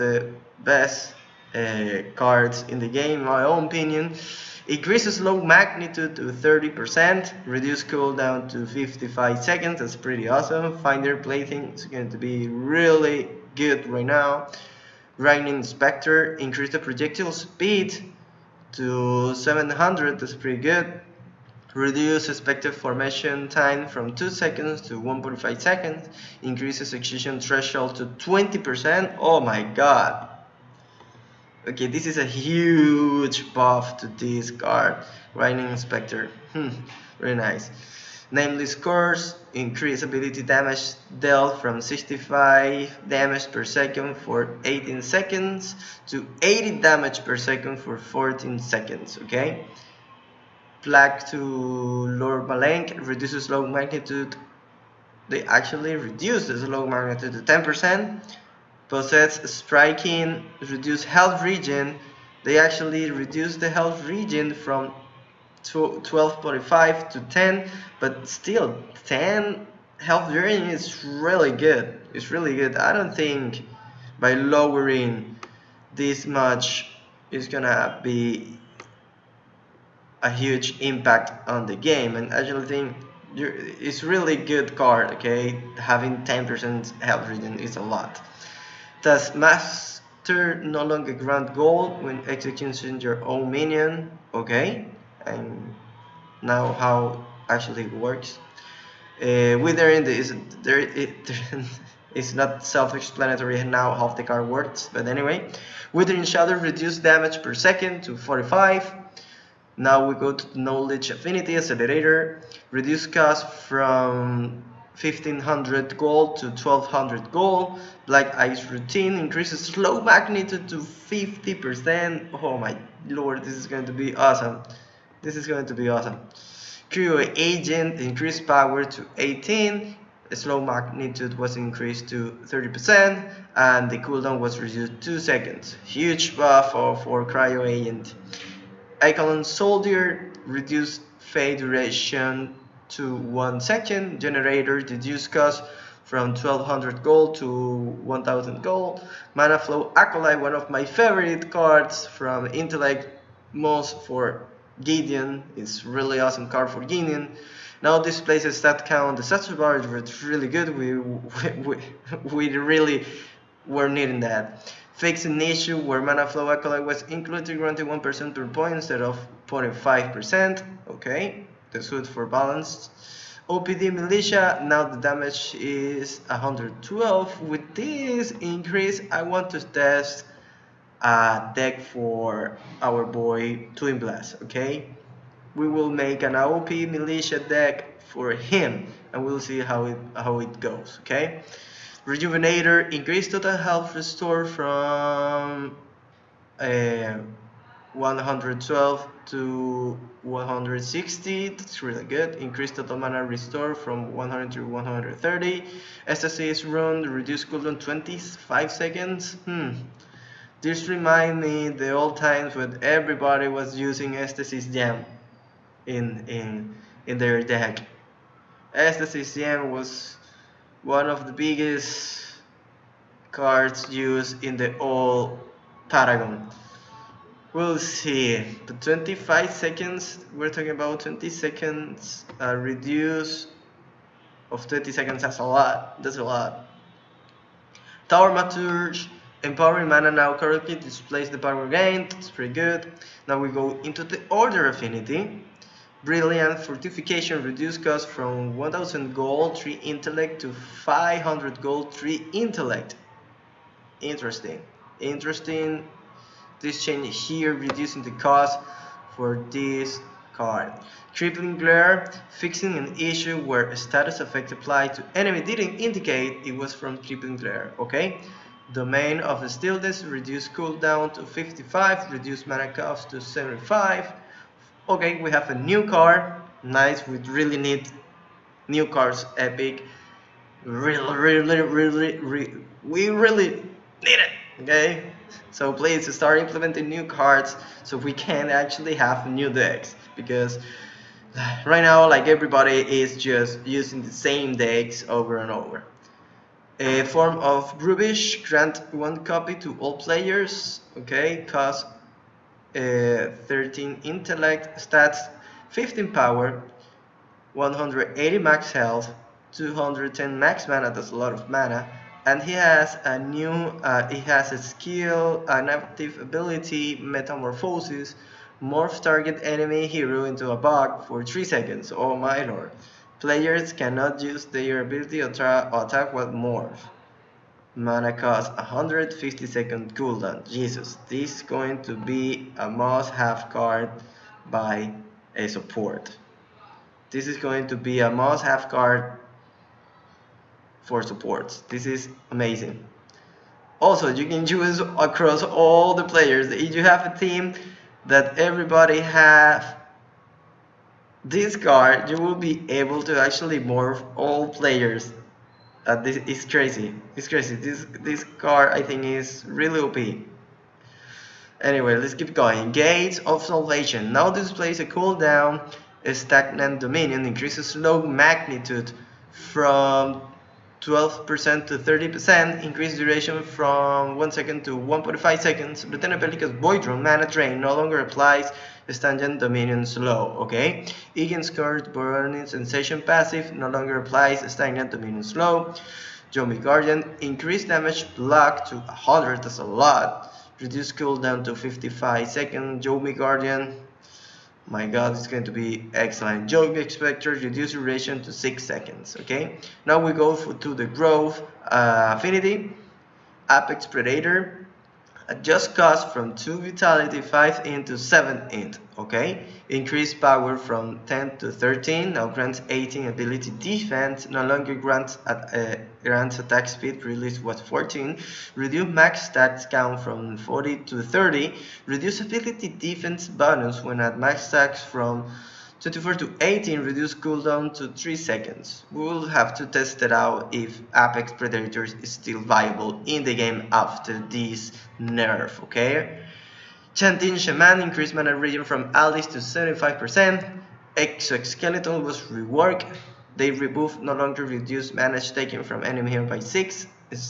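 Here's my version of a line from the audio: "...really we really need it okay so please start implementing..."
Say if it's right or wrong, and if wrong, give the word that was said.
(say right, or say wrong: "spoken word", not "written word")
right.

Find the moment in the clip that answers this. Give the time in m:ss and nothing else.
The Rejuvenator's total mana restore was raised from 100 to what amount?
3:24.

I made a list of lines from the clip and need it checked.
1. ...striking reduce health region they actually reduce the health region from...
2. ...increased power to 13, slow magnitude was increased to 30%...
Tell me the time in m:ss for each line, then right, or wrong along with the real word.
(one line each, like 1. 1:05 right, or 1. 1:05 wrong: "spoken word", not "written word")
1. 0:59 right
2. 2:07 wrong: "18", not "13".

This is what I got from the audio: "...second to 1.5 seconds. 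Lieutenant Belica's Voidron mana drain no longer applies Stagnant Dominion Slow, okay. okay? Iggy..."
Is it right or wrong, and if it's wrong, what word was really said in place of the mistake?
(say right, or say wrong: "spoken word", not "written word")
right.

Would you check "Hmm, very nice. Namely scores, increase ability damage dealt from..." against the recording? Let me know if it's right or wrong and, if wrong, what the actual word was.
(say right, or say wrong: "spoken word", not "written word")
right.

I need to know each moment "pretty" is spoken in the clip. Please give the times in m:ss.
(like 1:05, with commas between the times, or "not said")
0:09, 0:20, 4:02.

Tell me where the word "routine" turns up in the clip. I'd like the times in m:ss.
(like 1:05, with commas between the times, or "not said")
1:58.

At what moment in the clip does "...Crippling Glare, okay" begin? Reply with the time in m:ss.
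4:26.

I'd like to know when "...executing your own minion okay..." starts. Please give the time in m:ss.
1:32.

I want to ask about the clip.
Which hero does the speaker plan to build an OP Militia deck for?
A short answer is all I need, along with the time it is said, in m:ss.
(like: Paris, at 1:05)
Twin Blast, at 3:03.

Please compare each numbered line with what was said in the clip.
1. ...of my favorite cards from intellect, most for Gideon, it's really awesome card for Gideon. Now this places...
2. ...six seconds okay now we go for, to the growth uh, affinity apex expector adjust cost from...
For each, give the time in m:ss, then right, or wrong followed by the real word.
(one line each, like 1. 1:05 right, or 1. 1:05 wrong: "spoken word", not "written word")
1. 2:30 right
2. 6:38 wrong: "predator", not "expector".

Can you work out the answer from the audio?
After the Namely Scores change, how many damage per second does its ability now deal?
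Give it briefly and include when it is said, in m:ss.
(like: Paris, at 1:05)
80, at 0:46.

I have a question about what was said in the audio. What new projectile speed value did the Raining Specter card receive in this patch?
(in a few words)
700.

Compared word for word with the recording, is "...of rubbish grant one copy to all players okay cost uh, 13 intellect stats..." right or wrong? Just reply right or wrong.
right.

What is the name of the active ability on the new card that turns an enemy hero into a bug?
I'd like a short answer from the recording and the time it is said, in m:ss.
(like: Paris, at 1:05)
Metamorphosis, at 5:16.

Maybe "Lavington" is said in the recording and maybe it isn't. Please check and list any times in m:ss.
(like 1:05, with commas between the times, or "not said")
not said.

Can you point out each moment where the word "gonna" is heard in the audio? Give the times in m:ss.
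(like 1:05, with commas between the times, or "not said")
1:17.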